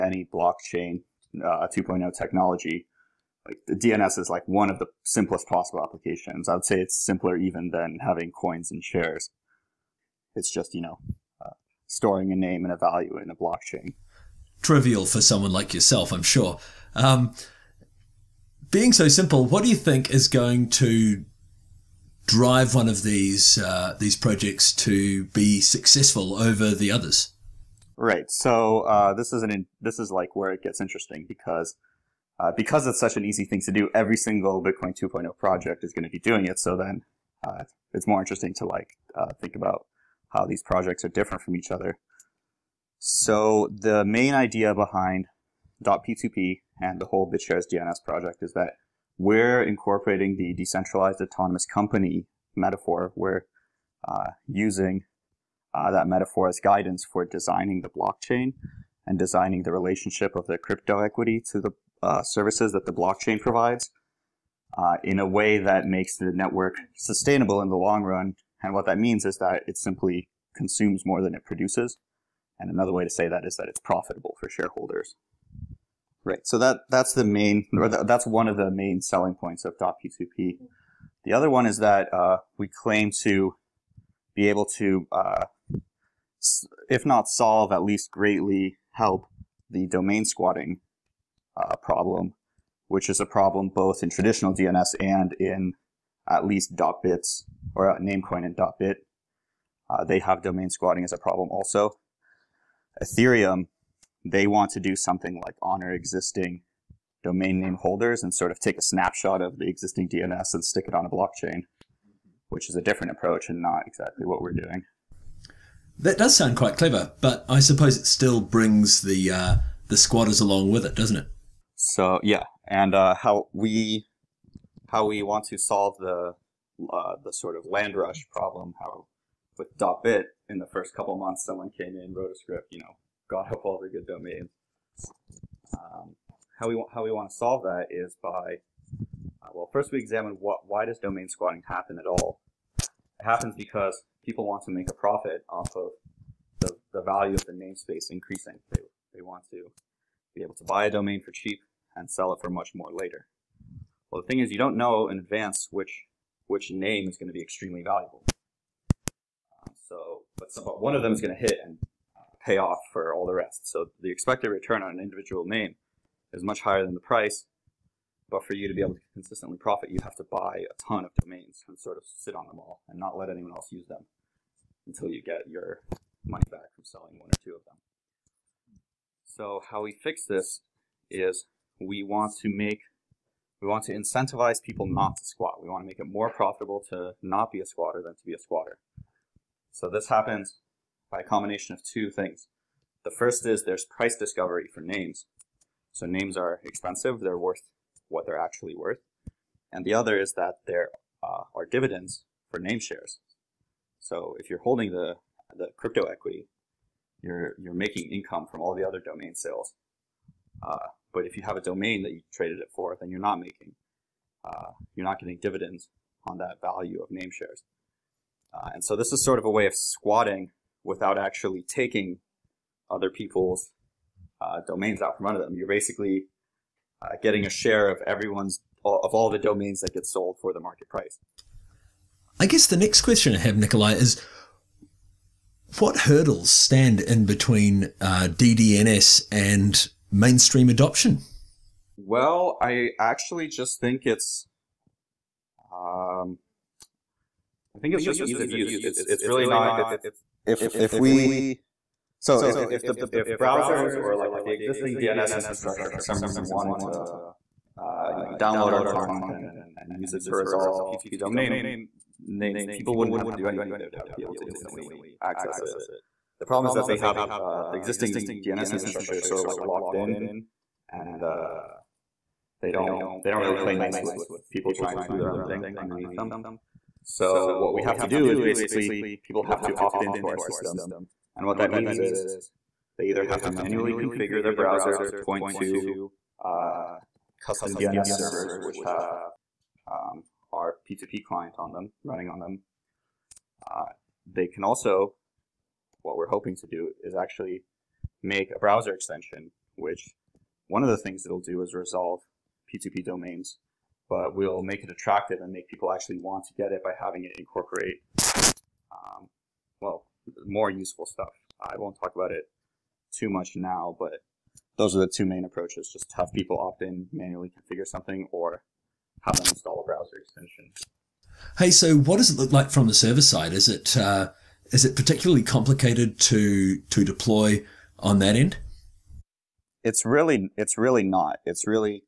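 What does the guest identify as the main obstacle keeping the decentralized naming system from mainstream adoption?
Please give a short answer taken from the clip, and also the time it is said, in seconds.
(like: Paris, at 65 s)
Ease of use, at 248 s.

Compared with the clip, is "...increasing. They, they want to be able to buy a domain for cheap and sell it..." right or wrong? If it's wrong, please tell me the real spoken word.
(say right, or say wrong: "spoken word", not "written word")
right.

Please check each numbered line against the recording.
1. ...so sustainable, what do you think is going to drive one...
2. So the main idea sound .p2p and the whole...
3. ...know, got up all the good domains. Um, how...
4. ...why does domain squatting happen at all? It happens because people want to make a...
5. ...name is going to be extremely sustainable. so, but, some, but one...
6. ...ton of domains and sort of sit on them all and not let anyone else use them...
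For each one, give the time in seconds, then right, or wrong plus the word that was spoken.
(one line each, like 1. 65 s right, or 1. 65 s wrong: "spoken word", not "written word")
1. 18 s wrong: "simple", not "sustainable"
2. 42 s wrong: "behind", not "sound"
3. 132 s right
4. 140 s right
5. 156 s wrong: "valuable", not "sustainable"
6. 170 s right.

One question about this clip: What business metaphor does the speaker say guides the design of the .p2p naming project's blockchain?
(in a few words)
Decentralized autonomous company.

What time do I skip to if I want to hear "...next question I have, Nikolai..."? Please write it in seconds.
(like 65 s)
232 s.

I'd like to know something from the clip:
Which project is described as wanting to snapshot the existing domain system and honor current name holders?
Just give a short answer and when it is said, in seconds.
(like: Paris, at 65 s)
Ethereum, at 103 s.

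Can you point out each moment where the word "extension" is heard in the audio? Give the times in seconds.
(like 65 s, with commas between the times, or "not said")
298 s, 320 s.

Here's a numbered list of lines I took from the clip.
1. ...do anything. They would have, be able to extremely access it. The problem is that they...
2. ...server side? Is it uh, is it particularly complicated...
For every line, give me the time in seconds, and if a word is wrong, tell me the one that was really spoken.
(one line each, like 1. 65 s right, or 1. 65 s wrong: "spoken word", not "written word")
1. 263 s wrong: "instantly", not "extremely"
2. 322 s right.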